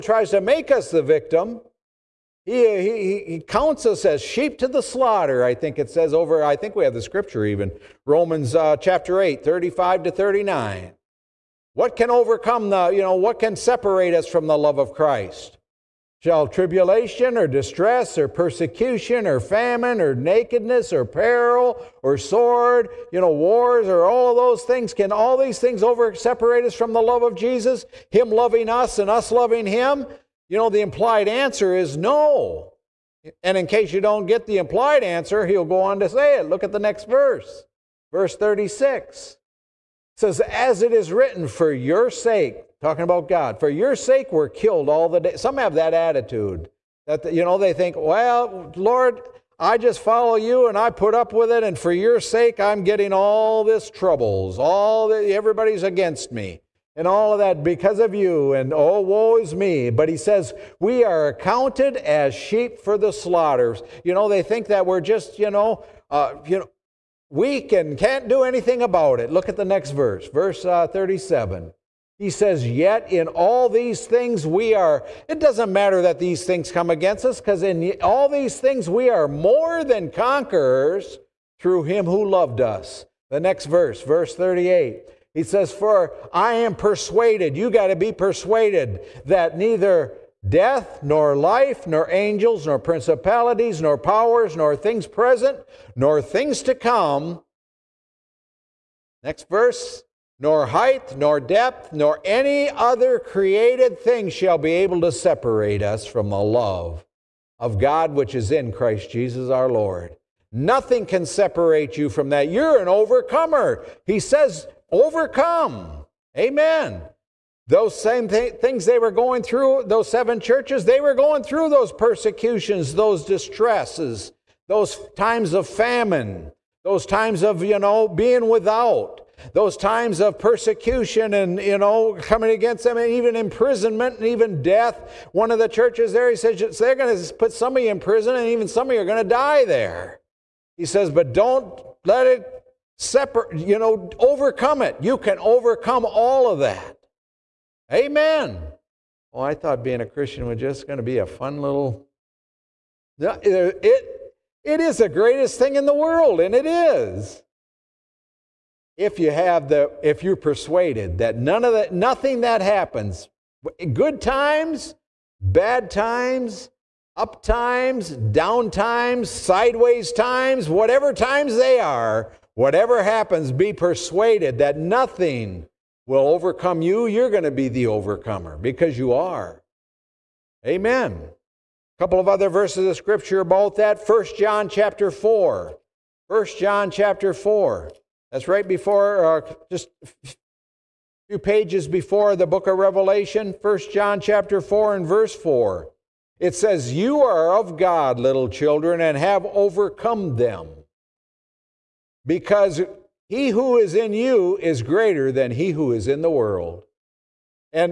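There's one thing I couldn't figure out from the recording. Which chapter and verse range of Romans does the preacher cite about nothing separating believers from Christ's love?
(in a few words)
8, 35 to 39.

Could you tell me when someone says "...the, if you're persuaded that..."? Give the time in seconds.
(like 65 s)
159 s.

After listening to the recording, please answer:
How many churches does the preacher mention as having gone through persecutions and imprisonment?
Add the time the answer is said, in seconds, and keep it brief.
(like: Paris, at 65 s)
7, at 120 s.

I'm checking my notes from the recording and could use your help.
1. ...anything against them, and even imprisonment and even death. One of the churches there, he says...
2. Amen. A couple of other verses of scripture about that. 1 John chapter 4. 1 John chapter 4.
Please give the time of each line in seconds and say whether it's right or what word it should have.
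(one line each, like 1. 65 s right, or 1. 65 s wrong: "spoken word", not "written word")
1. 132 s wrong: "coming", not "anything"
2. 180 s right.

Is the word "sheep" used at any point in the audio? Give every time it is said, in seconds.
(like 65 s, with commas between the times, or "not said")
4 s, 62 s.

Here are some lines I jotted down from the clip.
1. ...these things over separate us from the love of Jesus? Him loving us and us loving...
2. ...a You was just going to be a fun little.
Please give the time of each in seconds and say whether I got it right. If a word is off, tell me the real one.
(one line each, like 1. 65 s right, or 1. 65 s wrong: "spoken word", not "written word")
1. 25 s right
2. 150 s wrong: "Christian", not "You".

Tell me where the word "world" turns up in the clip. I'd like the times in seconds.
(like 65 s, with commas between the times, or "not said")
155 s, 206 s.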